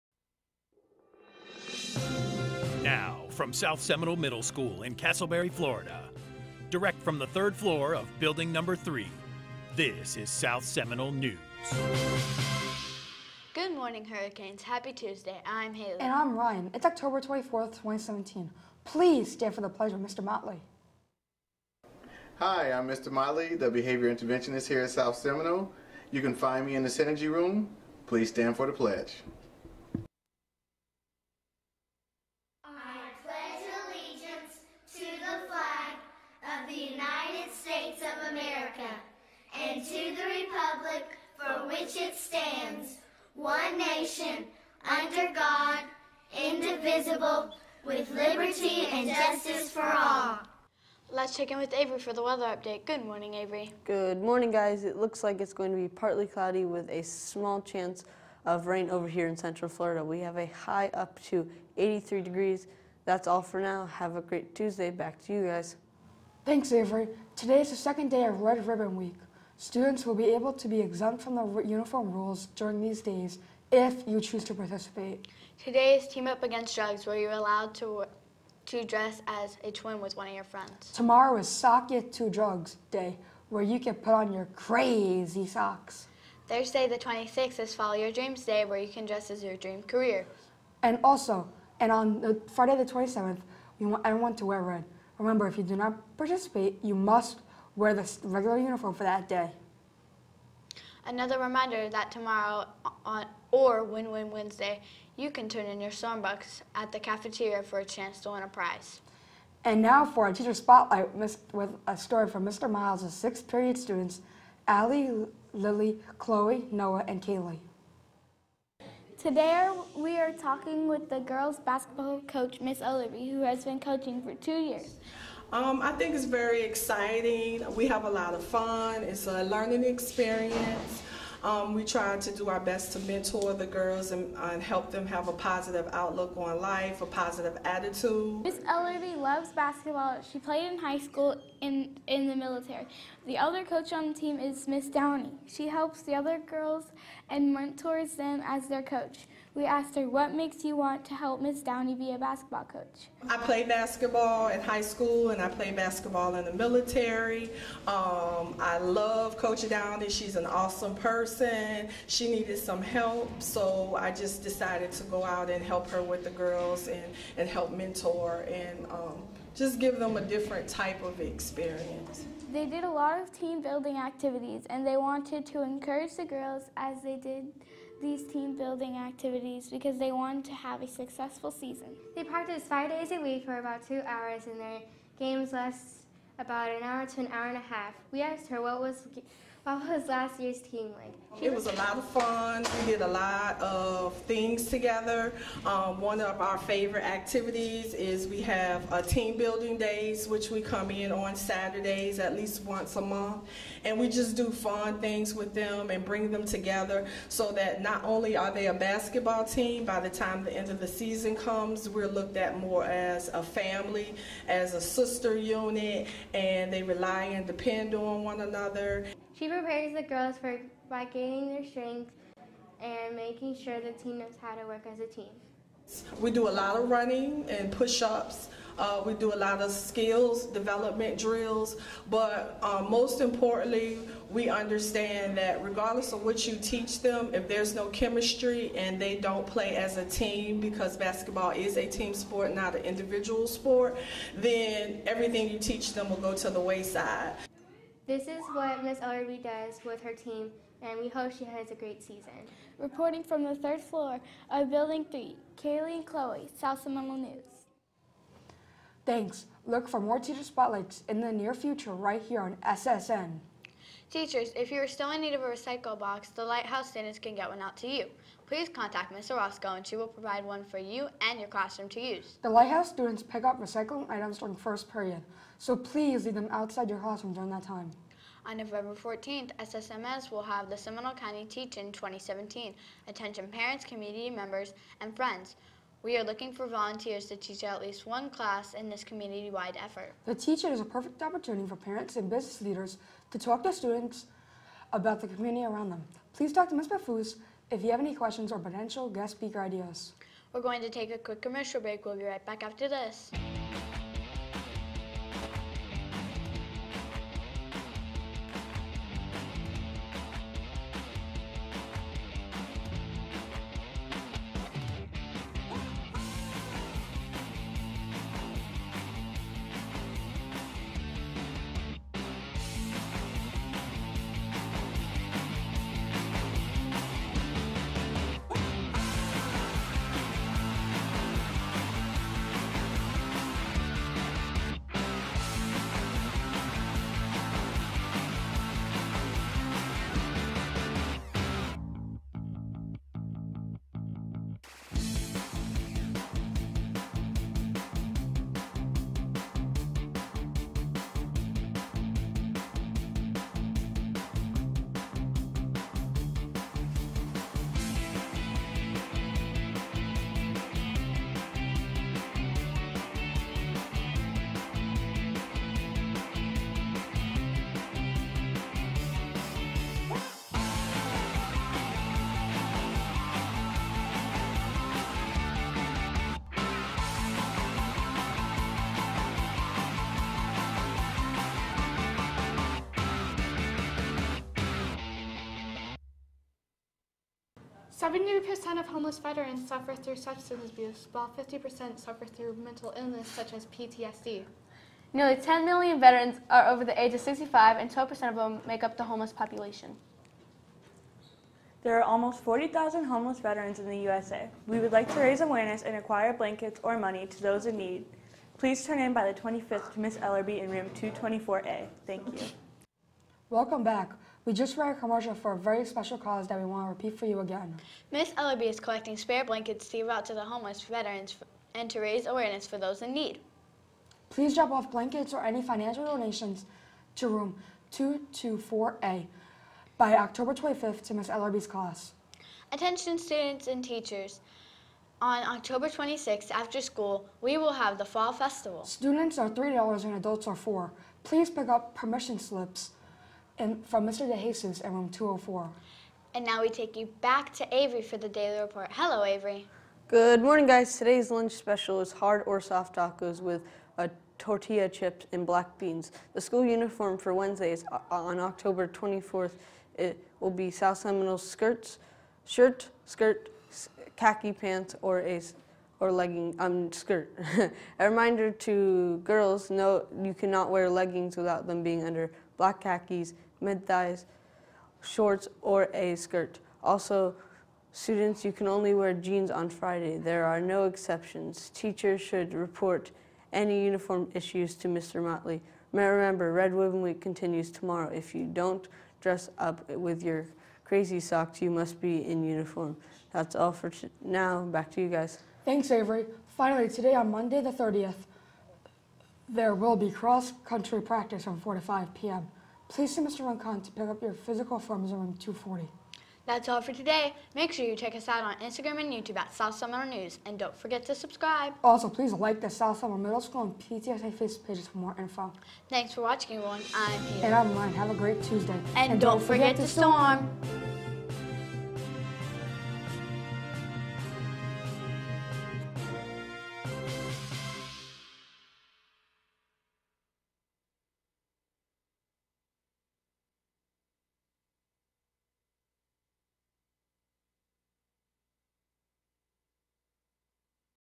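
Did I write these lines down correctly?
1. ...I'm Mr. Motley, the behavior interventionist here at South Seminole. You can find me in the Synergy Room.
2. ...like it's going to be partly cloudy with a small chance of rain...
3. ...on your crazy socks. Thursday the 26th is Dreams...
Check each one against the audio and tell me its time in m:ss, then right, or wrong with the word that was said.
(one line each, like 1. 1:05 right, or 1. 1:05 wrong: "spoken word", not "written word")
1. 0:22 right
2. 0:55 right
3. 1:24 wrong: "Follow", not "Dreams".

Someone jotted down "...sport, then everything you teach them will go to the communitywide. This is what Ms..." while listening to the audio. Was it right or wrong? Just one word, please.
wrong.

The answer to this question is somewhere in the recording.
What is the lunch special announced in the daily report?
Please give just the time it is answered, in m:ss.
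7:32.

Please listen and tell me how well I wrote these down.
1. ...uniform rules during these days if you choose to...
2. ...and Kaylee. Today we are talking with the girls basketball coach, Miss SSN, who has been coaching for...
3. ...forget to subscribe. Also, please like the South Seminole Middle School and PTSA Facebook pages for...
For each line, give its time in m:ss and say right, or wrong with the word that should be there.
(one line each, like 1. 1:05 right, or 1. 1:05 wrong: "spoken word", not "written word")
1. 1:11 right
2. 1:57 wrong: "Olivery", not "SSN"
3. 8:30 right.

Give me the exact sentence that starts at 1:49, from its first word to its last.
And now for our teacher spotlight with a story from Mr.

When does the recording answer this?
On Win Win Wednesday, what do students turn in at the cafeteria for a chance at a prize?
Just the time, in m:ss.
1:45.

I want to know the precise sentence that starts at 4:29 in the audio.
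Orozco and she will provide one for you and your classroom to use.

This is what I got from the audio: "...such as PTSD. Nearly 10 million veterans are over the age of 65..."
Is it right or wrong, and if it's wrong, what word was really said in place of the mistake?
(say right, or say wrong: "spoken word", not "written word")
right.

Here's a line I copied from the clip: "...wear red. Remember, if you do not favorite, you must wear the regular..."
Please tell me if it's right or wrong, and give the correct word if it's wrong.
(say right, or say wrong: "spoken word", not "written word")
wrong: "participate", not "favorite".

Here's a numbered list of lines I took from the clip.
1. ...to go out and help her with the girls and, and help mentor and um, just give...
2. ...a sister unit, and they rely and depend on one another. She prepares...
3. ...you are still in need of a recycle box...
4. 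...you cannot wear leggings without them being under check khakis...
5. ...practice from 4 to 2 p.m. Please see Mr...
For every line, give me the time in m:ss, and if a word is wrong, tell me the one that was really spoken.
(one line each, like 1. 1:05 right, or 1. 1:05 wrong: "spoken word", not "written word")
1. 2:44 right
2. 3:34 right
3. 4:24 right
4. 7:50 wrong: "black", not "check"
5. 8:21 wrong: "5", not "2".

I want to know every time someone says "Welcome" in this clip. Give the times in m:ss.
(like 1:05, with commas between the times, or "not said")
6:53.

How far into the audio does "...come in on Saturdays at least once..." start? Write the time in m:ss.
3:20.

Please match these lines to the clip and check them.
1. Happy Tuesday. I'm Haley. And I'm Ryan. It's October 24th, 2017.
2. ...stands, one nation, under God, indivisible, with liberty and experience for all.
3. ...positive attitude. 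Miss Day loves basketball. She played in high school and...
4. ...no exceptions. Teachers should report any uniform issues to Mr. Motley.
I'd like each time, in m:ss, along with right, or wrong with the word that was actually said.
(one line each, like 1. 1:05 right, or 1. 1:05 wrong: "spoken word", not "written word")
1. 0:14 right
2. 0:42 wrong: "justice", not "experience"
3. 2:17 wrong: "Ellery", not "Day"
4. 8:00 right.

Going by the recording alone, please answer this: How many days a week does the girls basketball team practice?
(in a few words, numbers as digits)
5.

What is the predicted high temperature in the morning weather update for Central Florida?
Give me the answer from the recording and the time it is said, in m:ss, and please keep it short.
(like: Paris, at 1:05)
83 degrees, at 1:01.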